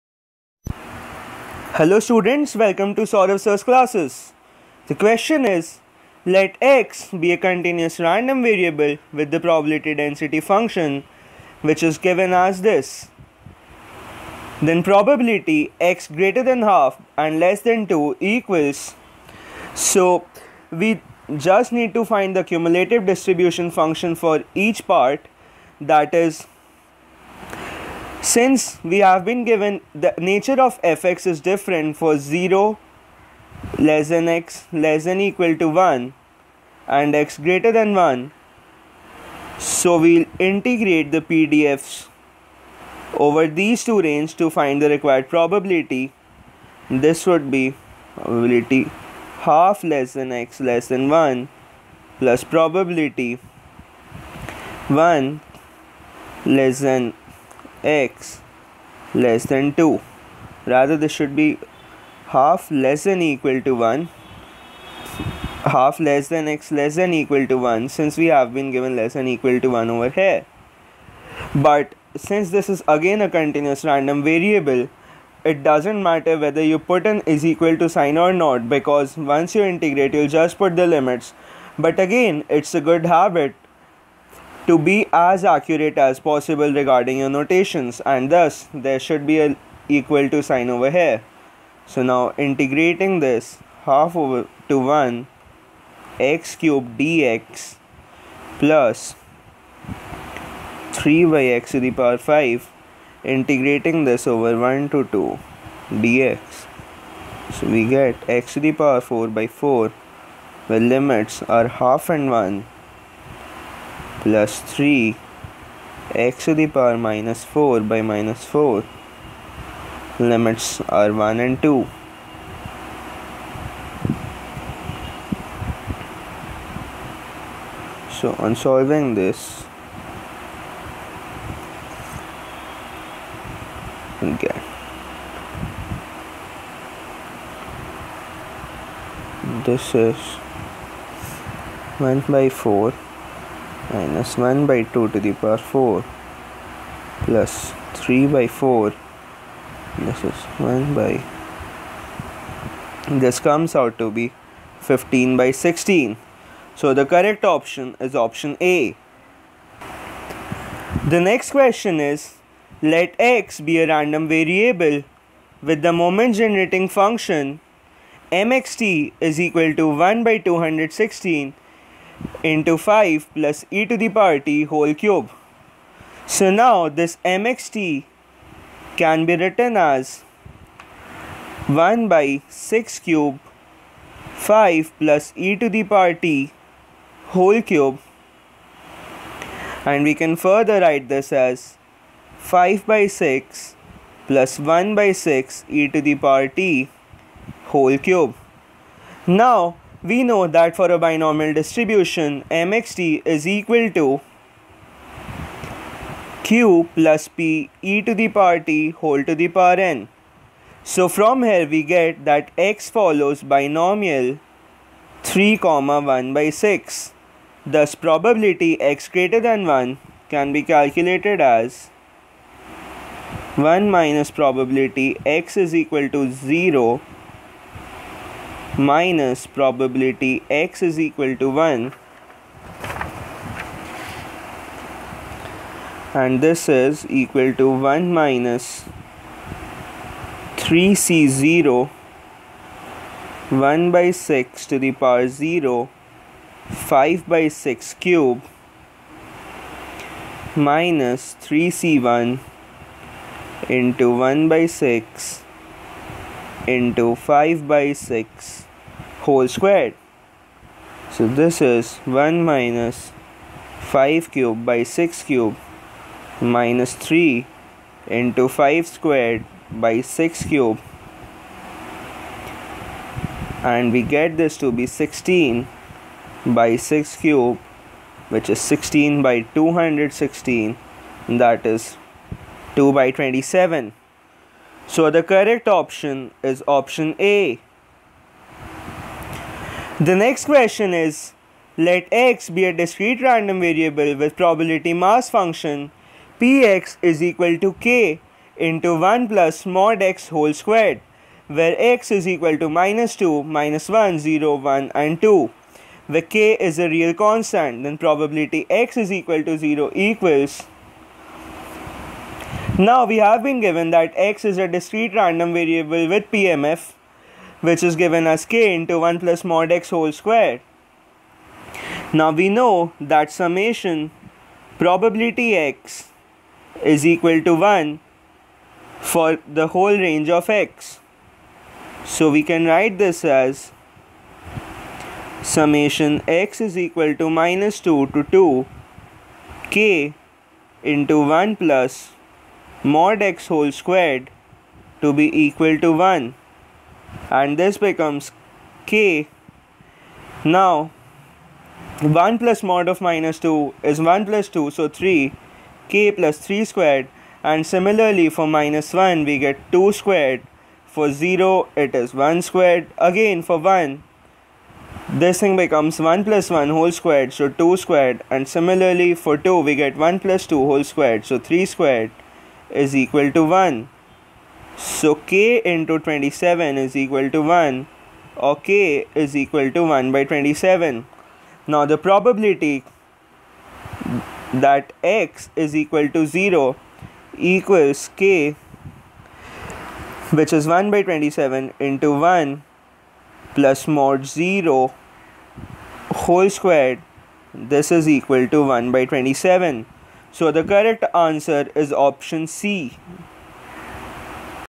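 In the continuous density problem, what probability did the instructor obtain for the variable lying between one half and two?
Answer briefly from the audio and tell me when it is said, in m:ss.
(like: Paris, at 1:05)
15/16, at 2:34.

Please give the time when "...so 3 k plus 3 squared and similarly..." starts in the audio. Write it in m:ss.
5:54.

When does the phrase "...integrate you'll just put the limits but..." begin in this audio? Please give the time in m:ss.
1:19.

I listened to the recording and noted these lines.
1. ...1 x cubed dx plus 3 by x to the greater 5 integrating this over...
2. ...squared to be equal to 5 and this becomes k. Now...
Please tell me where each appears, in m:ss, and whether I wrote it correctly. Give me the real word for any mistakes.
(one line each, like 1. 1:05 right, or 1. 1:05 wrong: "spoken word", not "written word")
1. 1:34 wrong: "power", not "greater"
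2. 5:43 wrong: "1", not "5".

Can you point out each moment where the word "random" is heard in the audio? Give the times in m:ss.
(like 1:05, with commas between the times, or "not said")
0:07, 1:13, 2:43, 4:53, 5:15.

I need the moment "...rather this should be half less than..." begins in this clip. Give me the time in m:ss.
1:00.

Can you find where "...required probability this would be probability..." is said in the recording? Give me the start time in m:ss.
0:44.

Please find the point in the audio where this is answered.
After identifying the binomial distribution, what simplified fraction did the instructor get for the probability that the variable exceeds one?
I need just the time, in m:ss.
4:42.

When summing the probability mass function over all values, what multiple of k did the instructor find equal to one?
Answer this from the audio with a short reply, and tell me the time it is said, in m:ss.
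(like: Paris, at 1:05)
27, at 6:15.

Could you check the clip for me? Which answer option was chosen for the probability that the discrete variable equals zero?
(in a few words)
Option C.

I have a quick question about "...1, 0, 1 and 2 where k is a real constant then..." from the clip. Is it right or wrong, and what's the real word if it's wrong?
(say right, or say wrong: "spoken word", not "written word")
right.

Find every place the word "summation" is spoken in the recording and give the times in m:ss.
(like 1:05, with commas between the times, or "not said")
5:23, 5:35.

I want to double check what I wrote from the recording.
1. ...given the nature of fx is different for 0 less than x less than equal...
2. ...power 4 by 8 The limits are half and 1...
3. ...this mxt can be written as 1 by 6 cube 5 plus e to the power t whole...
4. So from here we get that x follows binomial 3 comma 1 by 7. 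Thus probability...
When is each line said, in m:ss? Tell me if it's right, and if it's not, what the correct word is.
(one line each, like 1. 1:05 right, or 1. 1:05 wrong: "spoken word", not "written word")
1. 0:29 right
2. 1:48 wrong: "4", not "8"
3. 2:56 right
4. 3:30 wrong: "6", not "7".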